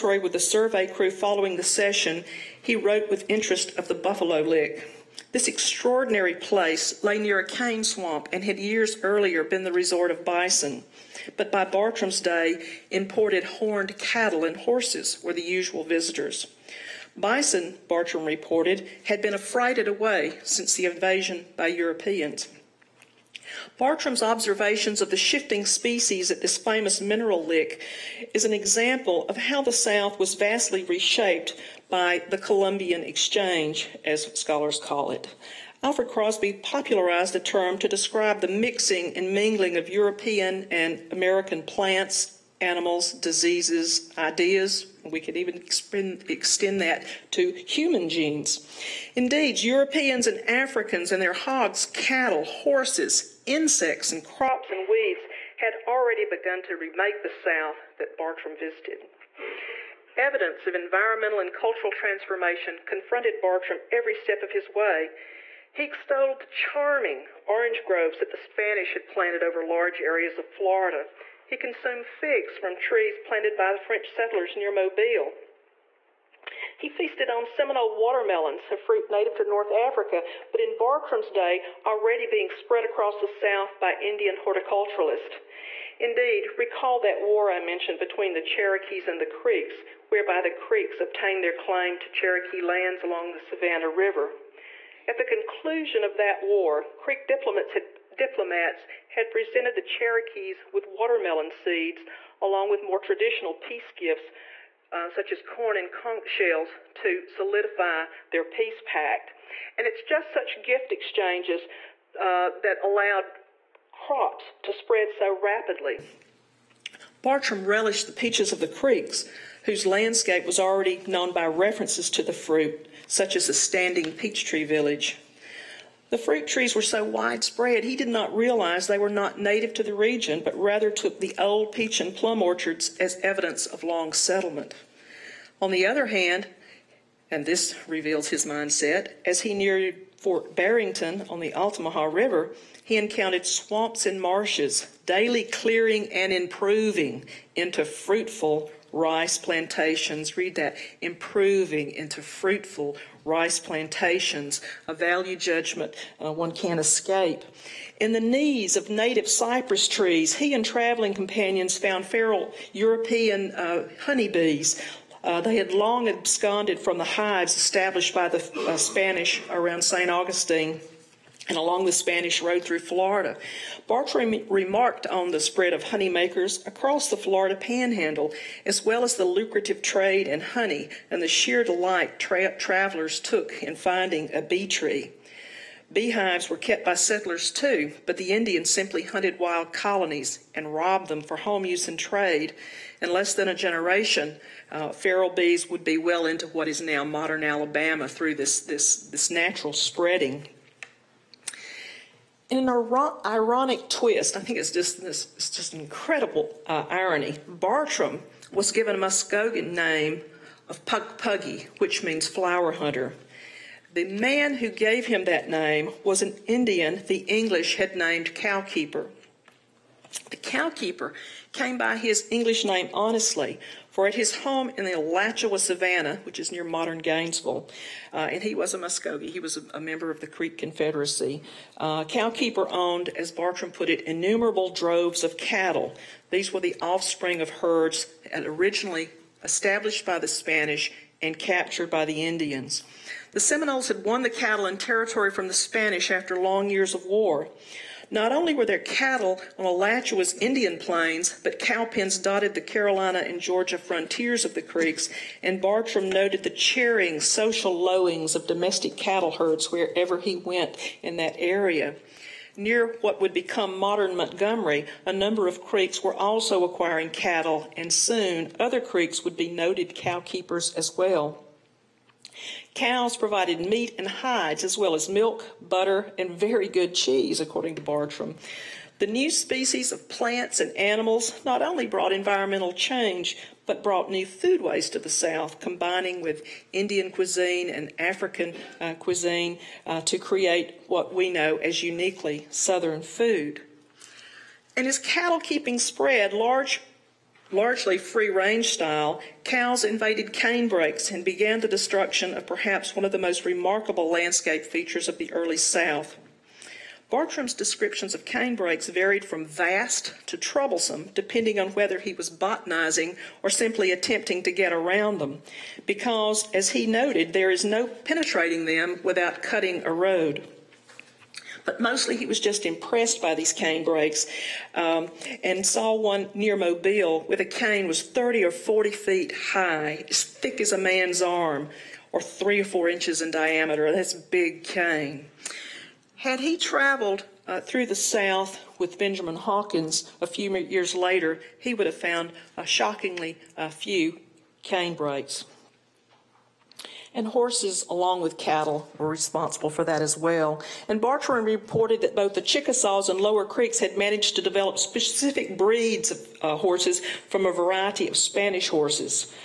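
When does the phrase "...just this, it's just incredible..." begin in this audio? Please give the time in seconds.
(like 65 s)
204 s.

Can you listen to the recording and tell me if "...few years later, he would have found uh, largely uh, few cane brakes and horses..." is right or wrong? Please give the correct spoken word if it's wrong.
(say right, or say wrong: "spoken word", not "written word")
wrong: "shockingly", not "largely".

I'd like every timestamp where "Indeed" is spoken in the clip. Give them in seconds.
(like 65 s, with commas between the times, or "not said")
49 s, 85 s.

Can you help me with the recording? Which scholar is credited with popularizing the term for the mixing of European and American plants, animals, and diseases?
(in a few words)
Alfred Crosby.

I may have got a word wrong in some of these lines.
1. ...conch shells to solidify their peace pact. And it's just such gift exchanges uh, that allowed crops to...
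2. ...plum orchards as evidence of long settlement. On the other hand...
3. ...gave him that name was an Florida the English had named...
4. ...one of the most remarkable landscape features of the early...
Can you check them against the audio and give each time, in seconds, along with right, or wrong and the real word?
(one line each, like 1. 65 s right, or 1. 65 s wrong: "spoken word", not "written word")
1. 105 s right
2. 132 s right
3. 214 s wrong: "Indian", not "Florida"
4. 302 s right.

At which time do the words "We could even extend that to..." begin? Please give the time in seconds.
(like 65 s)
45 s.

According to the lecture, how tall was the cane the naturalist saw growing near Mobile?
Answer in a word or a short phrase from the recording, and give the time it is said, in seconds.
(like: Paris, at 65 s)
30 or 40 feet, at 328 s.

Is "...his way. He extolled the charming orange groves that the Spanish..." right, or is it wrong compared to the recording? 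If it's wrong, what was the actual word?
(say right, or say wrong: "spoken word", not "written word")
right.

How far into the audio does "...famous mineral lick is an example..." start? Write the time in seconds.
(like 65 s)
26 s.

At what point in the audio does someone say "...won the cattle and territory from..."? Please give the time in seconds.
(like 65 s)
244 s.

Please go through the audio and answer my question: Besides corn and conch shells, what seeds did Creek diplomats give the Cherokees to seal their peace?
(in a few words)
Watermelon seeds.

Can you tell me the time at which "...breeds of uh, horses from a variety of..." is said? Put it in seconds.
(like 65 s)
355 s.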